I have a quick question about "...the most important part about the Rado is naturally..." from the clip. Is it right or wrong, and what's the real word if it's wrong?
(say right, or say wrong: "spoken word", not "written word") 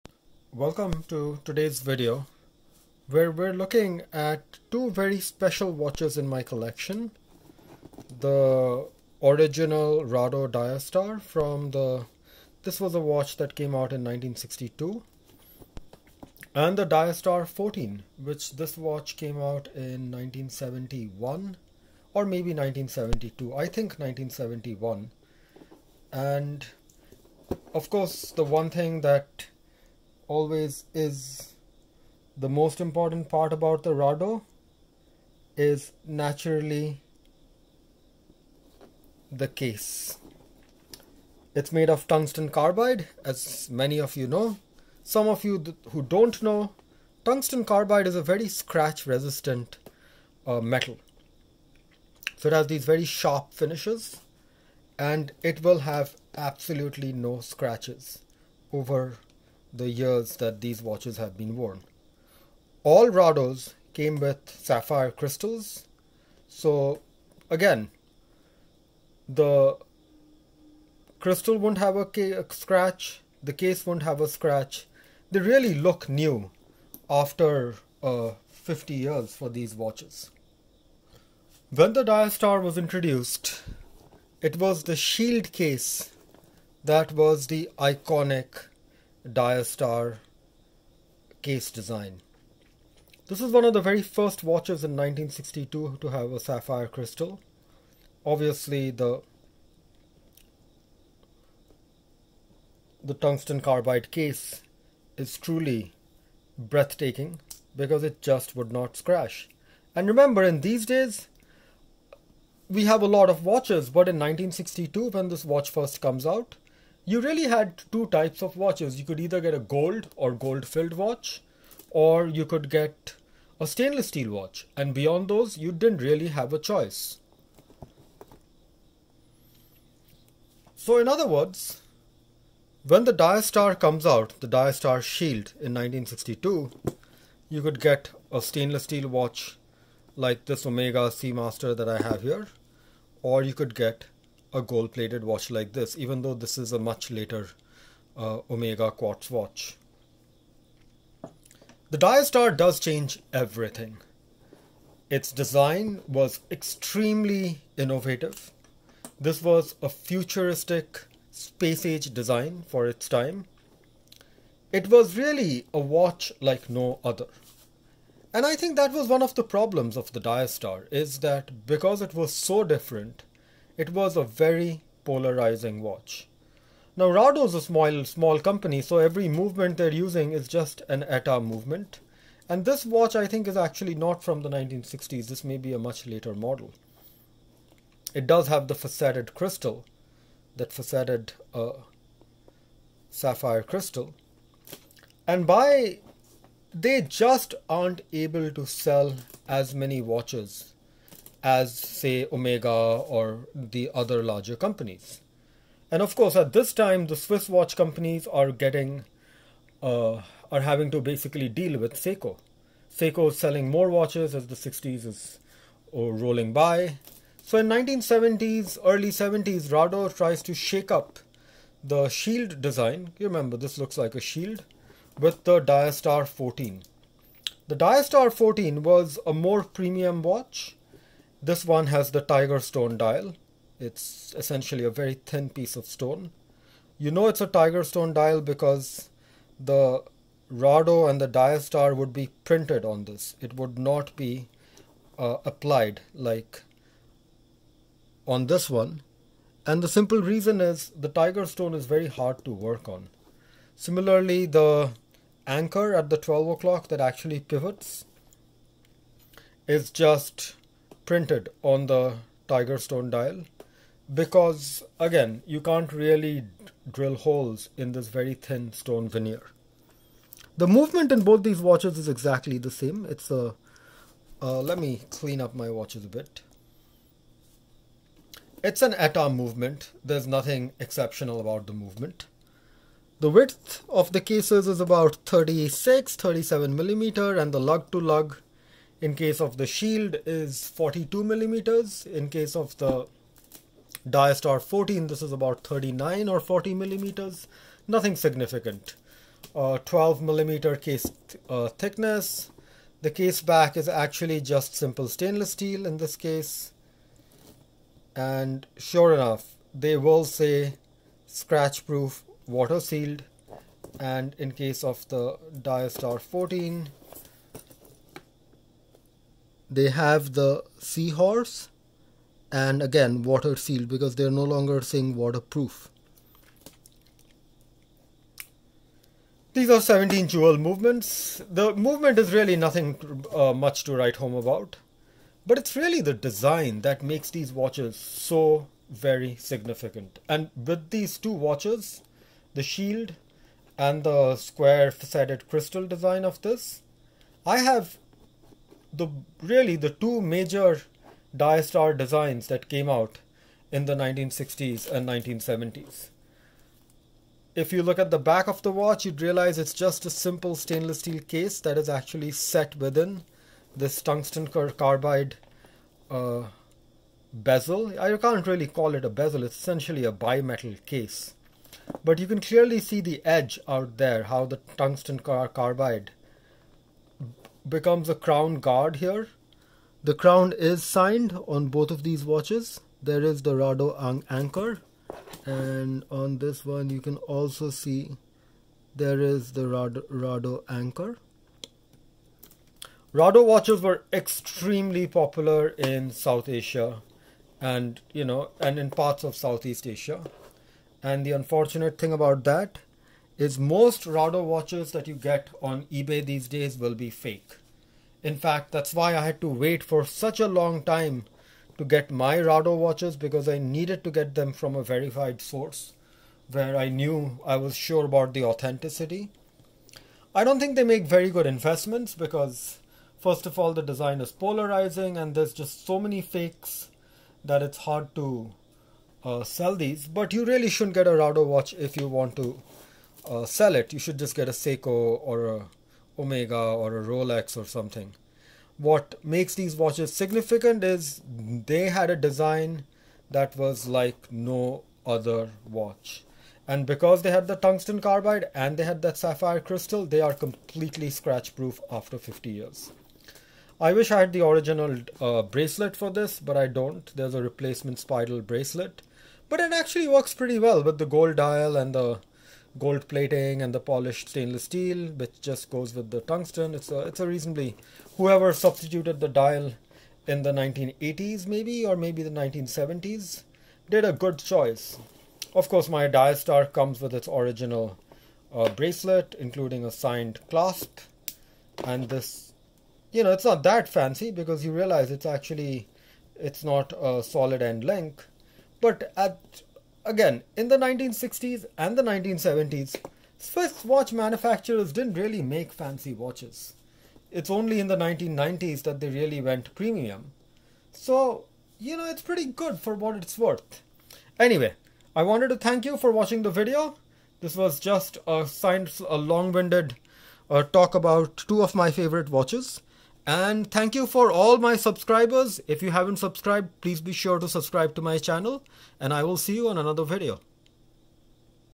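right.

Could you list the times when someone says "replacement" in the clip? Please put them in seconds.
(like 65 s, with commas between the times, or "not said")
457 s.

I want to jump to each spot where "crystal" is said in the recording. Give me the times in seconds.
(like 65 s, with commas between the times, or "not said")
65 s, 71 s, 96 s, 189 s, 193 s, 345 s, 449 s.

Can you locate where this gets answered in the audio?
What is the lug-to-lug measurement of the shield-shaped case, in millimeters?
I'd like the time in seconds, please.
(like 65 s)
290 s.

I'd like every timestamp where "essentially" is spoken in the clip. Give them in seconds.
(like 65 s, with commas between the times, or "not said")
234 s, 369 s.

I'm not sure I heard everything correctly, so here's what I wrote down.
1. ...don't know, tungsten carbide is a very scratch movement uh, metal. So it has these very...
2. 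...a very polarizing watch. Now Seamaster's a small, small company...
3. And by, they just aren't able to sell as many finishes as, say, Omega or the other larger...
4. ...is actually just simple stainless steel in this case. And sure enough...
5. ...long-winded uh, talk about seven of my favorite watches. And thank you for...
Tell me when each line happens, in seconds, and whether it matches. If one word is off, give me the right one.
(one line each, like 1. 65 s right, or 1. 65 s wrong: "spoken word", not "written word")
1. 46 s wrong: "resistant", not "movement"
2. 174 s wrong: "Rado", not "Seamaster"
3. 195 s wrong: "watches", not "finishes"
4. 303 s right
5. 509 s wrong: "two", not "seven".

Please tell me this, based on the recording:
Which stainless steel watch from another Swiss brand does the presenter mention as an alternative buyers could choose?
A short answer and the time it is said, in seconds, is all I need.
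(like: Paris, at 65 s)
Omega Seamaster, at 140 s.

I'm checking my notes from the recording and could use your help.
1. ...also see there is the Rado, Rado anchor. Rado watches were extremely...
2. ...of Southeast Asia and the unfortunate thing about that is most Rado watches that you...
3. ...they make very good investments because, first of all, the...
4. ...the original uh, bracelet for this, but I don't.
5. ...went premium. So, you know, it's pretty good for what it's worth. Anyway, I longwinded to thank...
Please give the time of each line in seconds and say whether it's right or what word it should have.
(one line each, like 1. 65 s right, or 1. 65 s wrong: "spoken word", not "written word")
1. 387 s right
2. 399 s right
3. 420 s right
4. 454 s right
5. 499 s wrong: "wanted", not "longwinded".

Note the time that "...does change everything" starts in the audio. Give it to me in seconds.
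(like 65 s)
152 s.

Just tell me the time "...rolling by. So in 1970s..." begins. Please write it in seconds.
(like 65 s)
216 s.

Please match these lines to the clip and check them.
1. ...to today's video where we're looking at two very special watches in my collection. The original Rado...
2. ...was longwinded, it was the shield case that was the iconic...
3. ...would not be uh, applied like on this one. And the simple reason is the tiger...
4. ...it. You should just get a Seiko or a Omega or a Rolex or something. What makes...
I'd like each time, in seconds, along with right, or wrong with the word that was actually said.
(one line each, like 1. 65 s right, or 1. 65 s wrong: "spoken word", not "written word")
1. 1 s right
2. 82 s wrong: "introduced", not "longwinded"
3. 243 s right
4. 433 s right.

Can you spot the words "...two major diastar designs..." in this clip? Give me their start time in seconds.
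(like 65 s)
349 s.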